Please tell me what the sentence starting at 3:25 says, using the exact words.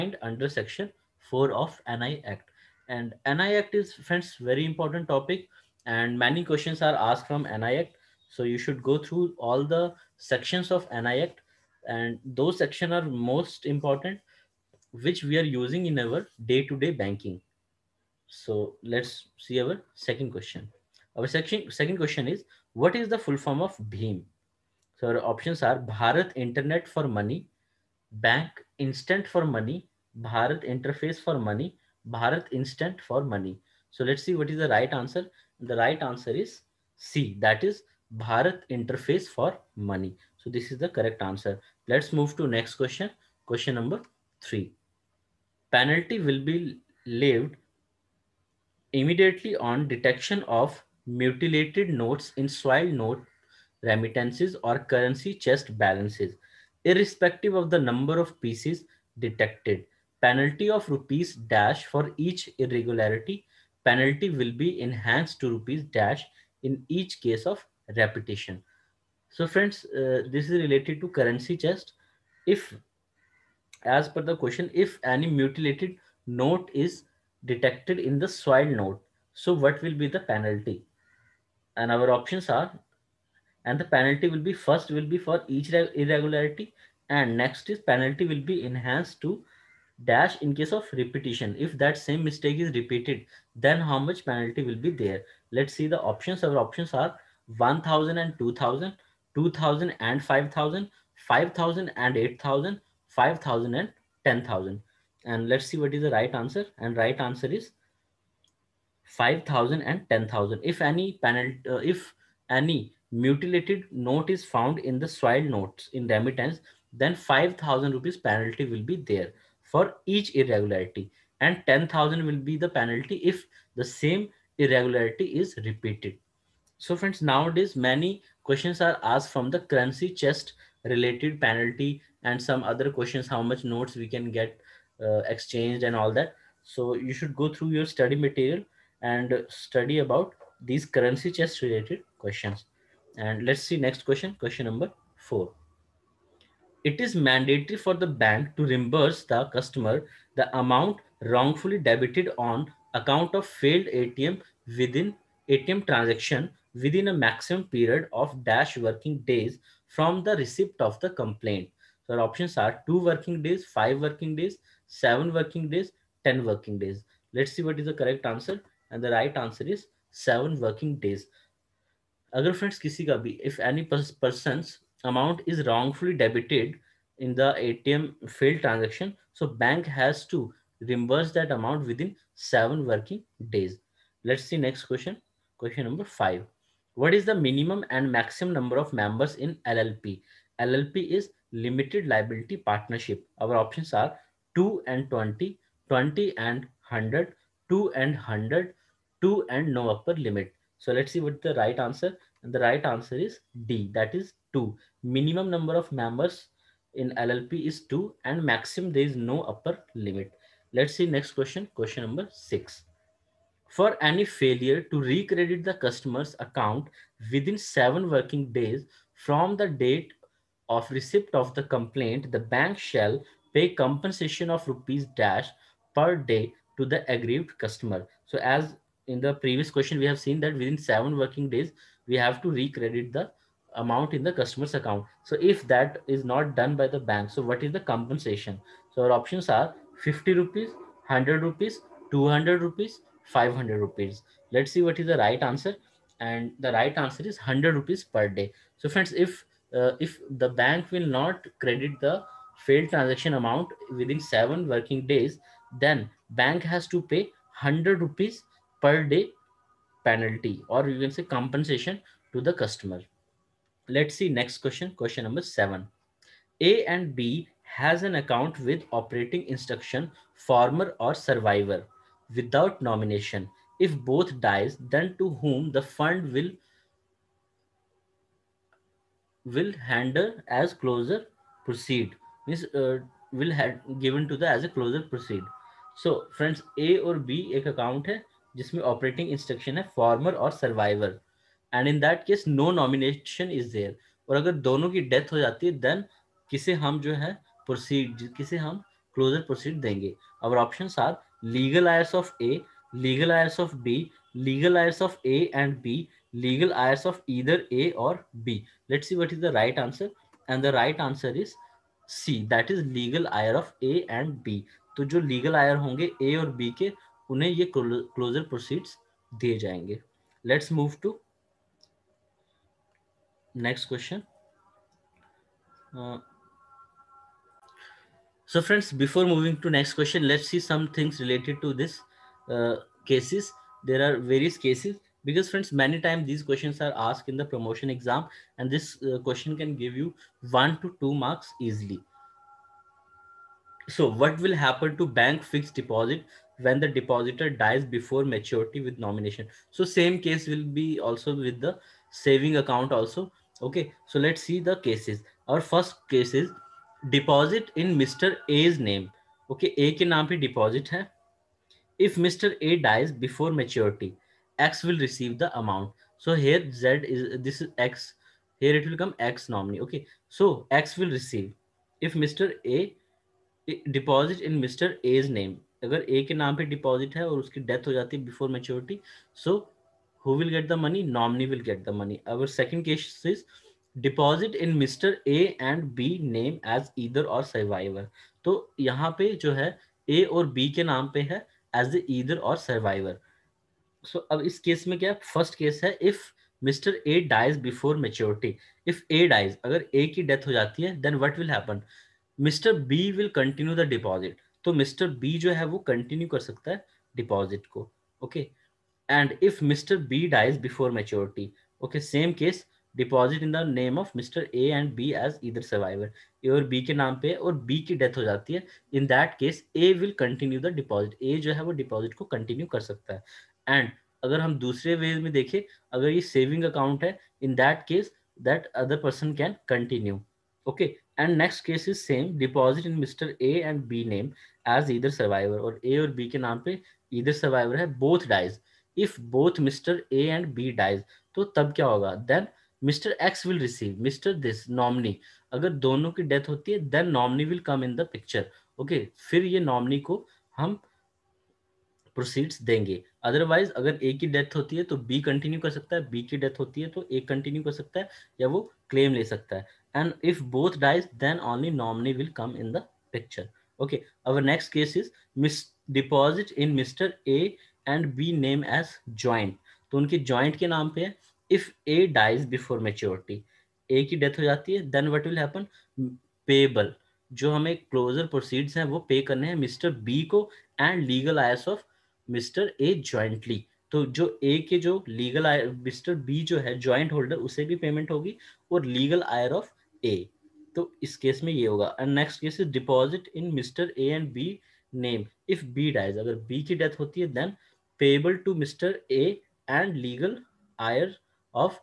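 Minimum number of members in LLP is 2 and maximum there is no upper limit.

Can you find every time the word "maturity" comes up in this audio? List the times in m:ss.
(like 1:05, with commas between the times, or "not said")
5:48, 6:03.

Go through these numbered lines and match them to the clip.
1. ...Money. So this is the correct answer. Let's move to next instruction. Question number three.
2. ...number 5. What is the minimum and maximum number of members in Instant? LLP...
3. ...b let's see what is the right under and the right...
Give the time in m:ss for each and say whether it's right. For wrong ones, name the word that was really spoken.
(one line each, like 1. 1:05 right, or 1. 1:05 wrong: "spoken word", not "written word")
1. 0:39 wrong: "question", not "instruction"
2. 3:05 wrong: "LLP", not "Instant"
3. 5:08 wrong: "answer", not "under".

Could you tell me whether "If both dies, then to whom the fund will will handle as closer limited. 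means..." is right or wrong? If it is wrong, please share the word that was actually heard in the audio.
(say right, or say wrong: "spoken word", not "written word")
wrong: "proceed", not "limited".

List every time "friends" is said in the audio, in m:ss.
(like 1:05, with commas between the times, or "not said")
0:03, 1:09, 2:06, 2:52, 4:08, 4:46, 5:35.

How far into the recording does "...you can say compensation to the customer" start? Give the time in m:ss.
4:20.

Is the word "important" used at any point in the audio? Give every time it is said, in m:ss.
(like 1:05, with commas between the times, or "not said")
0:04, 0:13.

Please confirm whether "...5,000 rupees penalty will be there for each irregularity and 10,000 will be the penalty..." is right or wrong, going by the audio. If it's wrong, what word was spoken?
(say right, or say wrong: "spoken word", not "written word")
right.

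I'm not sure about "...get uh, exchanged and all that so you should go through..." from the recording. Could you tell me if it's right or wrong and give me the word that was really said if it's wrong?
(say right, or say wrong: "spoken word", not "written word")
right.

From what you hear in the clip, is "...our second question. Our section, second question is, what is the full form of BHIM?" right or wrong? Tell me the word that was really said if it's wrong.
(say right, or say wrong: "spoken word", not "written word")
right.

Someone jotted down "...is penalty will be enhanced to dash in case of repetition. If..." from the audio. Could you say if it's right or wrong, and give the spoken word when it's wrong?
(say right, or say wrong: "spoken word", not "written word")
right.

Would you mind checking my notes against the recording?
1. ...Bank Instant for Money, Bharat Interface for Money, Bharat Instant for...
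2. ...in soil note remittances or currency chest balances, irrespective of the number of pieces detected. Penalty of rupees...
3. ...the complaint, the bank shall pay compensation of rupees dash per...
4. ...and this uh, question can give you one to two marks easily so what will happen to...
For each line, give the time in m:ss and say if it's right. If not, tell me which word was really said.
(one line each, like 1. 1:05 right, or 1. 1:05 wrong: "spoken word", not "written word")
1. 0:28 right
2. 0:52 right
3. 3:41 right
4. 5:38 right.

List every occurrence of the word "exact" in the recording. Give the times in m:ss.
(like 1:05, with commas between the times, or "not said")
not said.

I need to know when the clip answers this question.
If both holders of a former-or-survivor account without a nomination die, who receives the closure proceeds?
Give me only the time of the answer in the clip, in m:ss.
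5:04.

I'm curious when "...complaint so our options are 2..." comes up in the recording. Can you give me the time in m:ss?
2:41.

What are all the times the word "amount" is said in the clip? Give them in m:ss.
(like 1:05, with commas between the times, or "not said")
2:30, 2:55, 3:01, 3:53, 4:13, 6:05.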